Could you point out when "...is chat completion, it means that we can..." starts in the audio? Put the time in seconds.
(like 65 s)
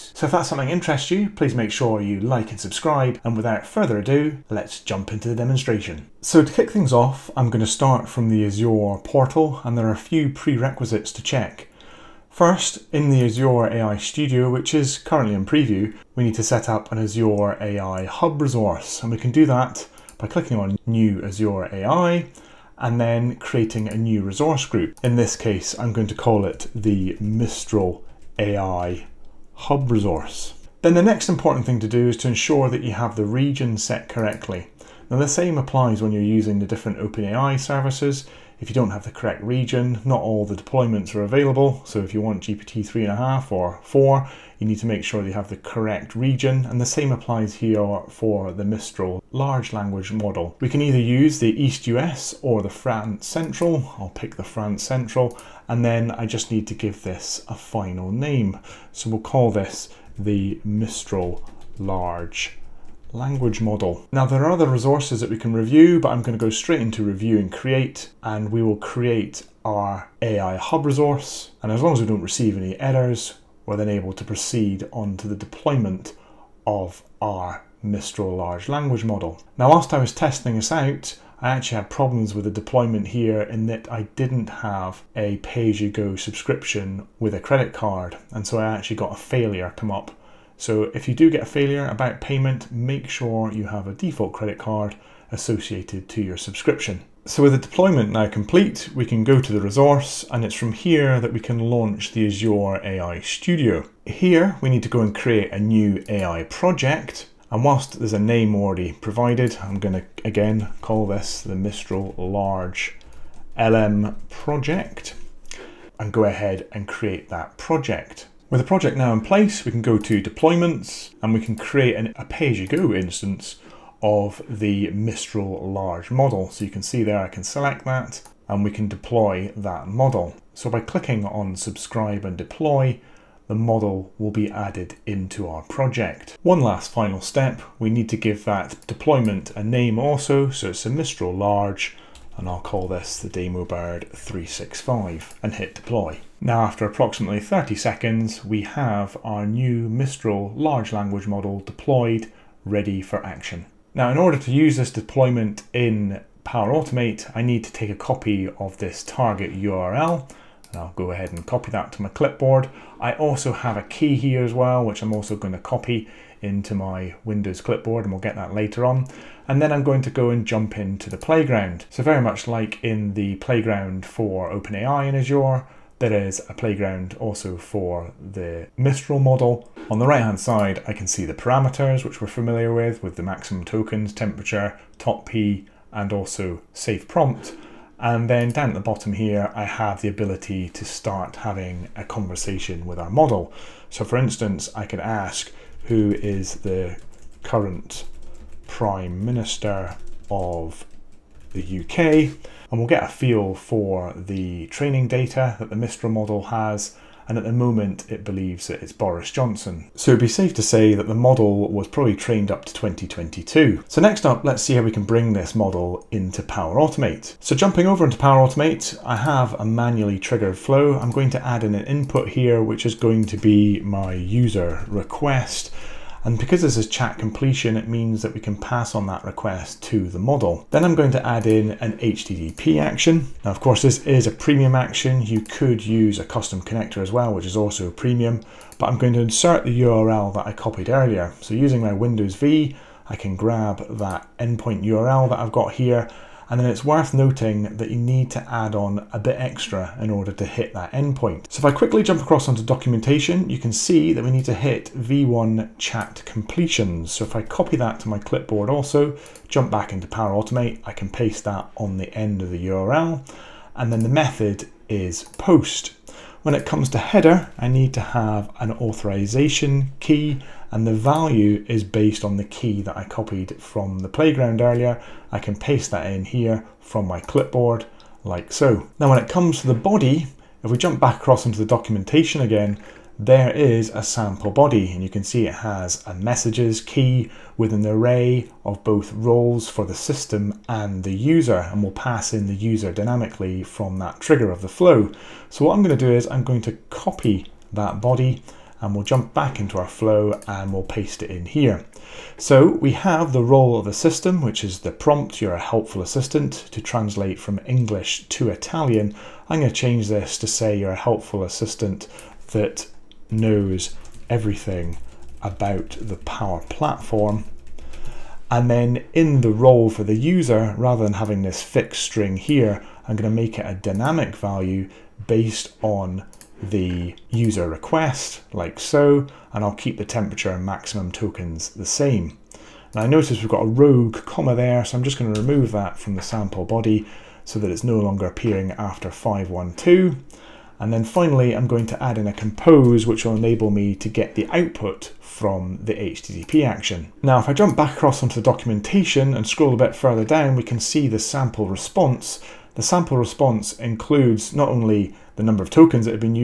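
226 s.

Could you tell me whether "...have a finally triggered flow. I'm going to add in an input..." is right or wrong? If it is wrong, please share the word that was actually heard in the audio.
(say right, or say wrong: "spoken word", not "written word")
wrong: "manually", not "finally".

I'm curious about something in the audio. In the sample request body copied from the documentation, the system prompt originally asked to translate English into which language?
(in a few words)
Italian.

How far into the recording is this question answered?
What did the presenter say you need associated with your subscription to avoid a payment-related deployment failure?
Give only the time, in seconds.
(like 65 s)
93 s.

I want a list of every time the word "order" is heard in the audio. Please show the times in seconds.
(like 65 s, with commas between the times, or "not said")
154 s, 250 s.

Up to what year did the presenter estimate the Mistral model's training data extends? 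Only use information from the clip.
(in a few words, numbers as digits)
2022.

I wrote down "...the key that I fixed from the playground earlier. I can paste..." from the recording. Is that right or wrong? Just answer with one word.
wrong.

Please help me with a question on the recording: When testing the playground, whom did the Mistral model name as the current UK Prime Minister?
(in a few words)
Boris Johnson.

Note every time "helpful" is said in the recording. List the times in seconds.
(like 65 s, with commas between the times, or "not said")
305 s, 310 s.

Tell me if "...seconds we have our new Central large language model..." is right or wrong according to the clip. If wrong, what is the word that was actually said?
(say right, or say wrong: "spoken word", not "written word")
wrong: "Mistral", not "Central".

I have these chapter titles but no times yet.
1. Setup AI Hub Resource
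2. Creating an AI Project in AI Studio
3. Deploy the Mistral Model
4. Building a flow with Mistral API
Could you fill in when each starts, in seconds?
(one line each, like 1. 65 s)
1. 5 s
2. 98 s
3. 117 s
4. 217 s.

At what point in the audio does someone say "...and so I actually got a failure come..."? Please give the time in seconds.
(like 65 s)
88 s.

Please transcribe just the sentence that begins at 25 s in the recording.
In this case, I'm going to call it the Mistral AI Hub resource.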